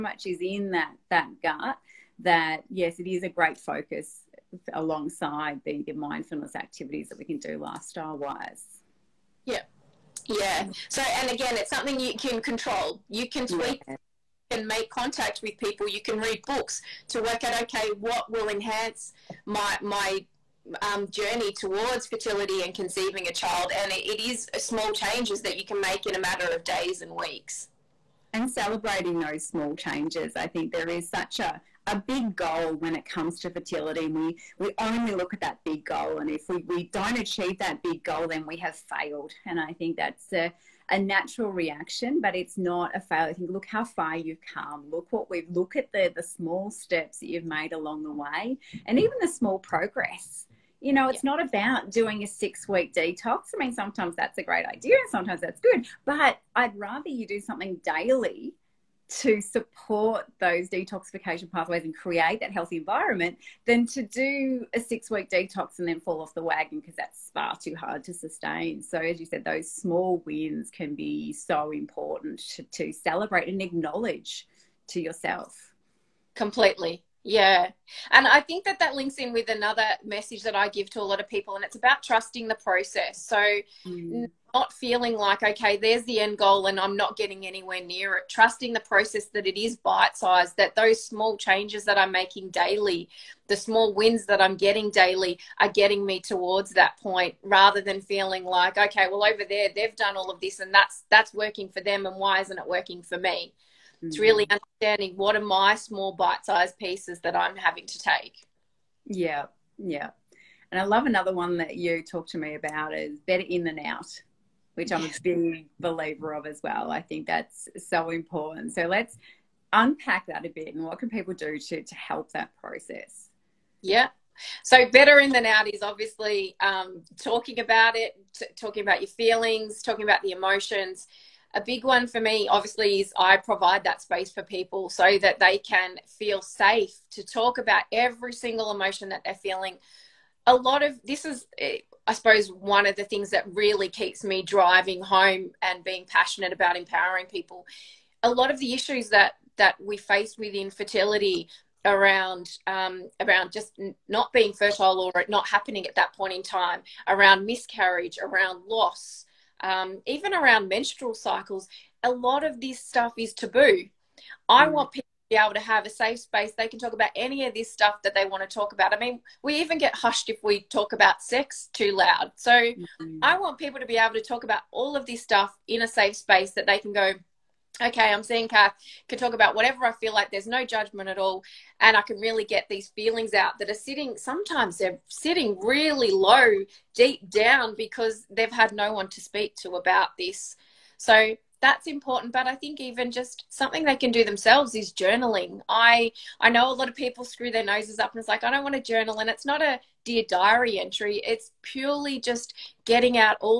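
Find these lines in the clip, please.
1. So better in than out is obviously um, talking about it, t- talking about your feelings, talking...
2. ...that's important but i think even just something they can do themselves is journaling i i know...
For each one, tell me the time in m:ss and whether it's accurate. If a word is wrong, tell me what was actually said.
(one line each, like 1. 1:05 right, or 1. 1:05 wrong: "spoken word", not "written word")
1. 2:04 right
2. 3:11 right.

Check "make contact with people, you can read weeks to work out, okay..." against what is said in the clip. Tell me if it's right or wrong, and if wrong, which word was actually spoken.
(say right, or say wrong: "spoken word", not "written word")
wrong: "books", not "weeks".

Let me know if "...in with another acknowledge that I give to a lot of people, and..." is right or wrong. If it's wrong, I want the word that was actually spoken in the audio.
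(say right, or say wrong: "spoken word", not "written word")
wrong: "message", not "acknowledge".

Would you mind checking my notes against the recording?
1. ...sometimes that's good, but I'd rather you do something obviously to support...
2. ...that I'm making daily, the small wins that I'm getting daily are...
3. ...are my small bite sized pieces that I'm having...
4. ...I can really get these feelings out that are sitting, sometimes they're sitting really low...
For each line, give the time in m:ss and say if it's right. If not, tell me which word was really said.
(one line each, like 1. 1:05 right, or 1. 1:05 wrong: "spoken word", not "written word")
1. 0:55 wrong: "daily", not "obviously"
2. 1:31 right
3. 1:45 right
4. 3:01 right.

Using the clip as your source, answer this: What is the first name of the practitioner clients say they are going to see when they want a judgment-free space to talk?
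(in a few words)
Cath.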